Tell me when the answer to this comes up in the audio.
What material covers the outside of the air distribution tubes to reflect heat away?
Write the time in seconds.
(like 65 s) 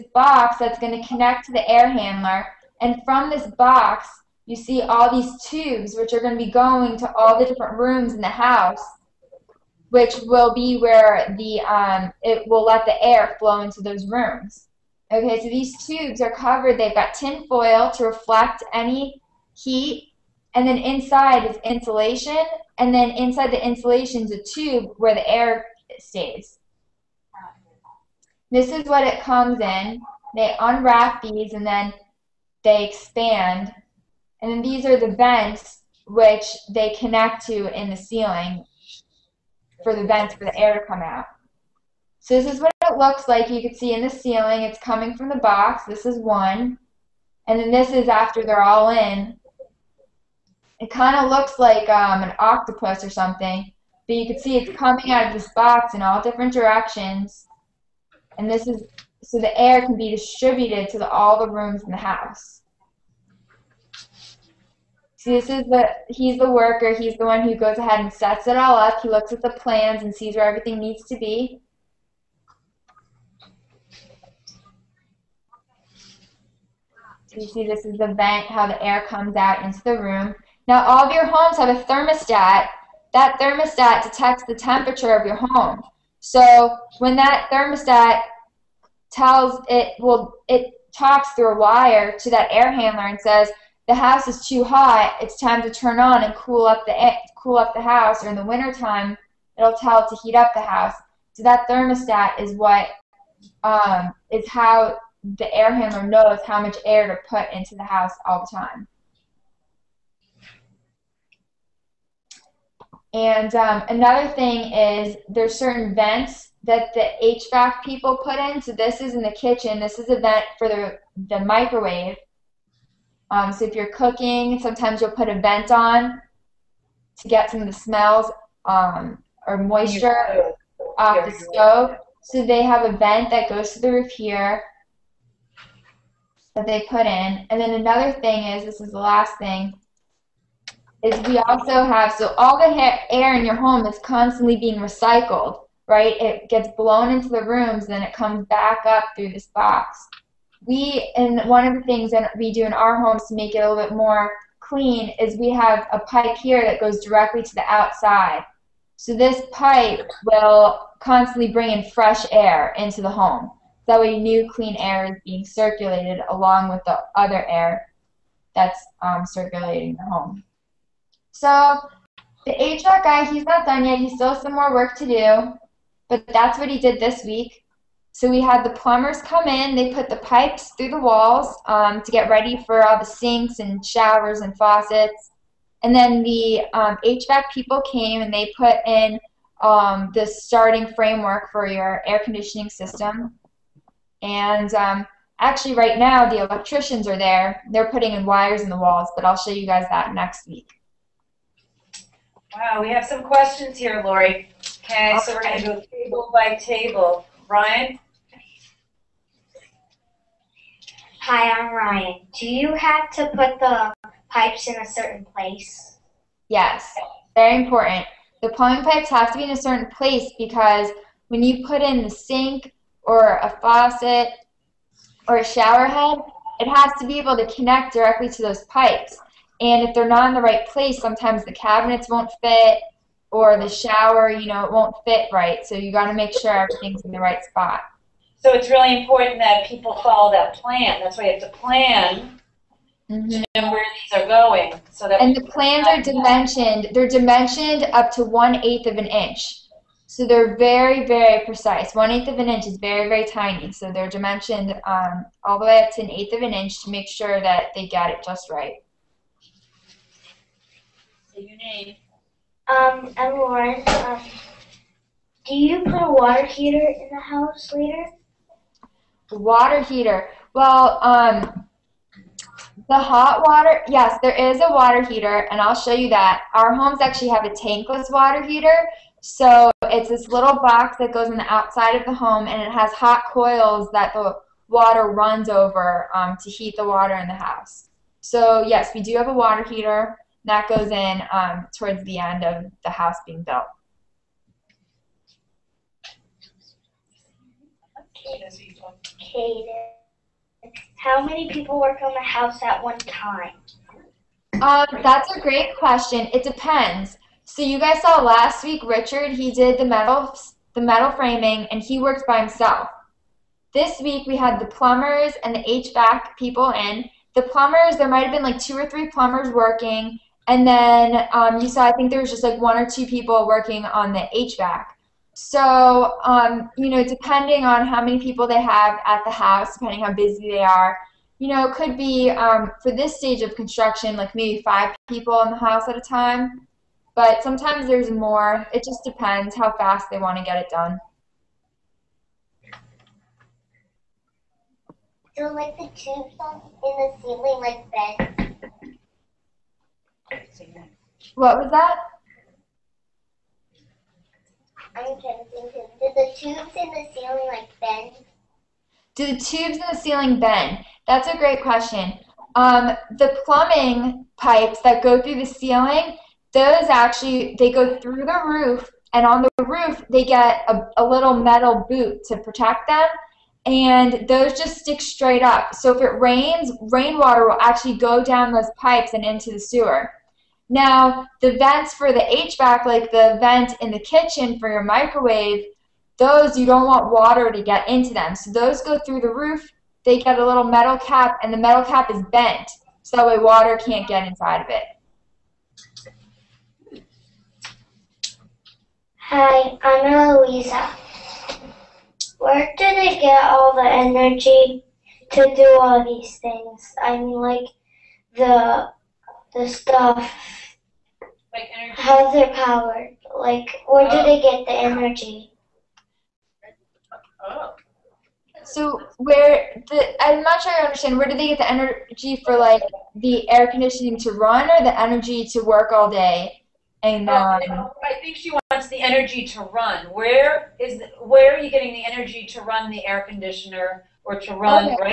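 17 s.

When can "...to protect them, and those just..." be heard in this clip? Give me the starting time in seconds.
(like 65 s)
372 s.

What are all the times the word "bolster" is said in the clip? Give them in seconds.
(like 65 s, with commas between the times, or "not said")
not said.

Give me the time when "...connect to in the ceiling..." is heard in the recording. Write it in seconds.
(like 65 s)
36 s.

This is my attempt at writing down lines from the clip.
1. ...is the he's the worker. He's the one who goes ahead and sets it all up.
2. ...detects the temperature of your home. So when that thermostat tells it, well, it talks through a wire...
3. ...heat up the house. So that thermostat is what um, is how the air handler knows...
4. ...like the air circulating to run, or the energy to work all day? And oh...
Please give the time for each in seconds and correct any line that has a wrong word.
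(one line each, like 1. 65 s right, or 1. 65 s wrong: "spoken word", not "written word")
1. 65 s right
2. 84 s right
3. 100 s right
4. 422 s wrong: "conditioning", not "circulating".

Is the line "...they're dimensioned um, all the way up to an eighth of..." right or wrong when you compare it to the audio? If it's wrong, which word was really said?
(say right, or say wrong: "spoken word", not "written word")
right.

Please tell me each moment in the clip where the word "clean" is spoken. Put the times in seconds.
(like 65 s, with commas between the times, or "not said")
154 s, 164 s.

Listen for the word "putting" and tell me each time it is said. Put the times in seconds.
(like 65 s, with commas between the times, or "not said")
197 s.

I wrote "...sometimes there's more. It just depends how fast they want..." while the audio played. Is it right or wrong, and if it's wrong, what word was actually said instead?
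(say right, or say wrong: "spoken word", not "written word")
right.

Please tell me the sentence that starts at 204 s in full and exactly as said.
Okay, so we're going to go table by table.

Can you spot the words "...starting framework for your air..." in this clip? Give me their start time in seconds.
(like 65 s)
190 s.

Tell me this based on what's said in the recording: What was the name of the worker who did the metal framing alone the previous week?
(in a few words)
Richard.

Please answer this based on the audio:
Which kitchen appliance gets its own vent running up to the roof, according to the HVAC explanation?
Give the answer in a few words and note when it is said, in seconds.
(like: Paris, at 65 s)
The microwave, at 121 s.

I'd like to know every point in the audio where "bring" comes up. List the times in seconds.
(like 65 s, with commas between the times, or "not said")
161 s.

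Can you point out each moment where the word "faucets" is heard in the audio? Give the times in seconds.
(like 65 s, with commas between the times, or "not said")
184 s, 223 s.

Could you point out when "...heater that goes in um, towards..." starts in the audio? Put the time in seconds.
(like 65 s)
289 s.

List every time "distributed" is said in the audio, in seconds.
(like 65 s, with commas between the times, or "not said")
60 s.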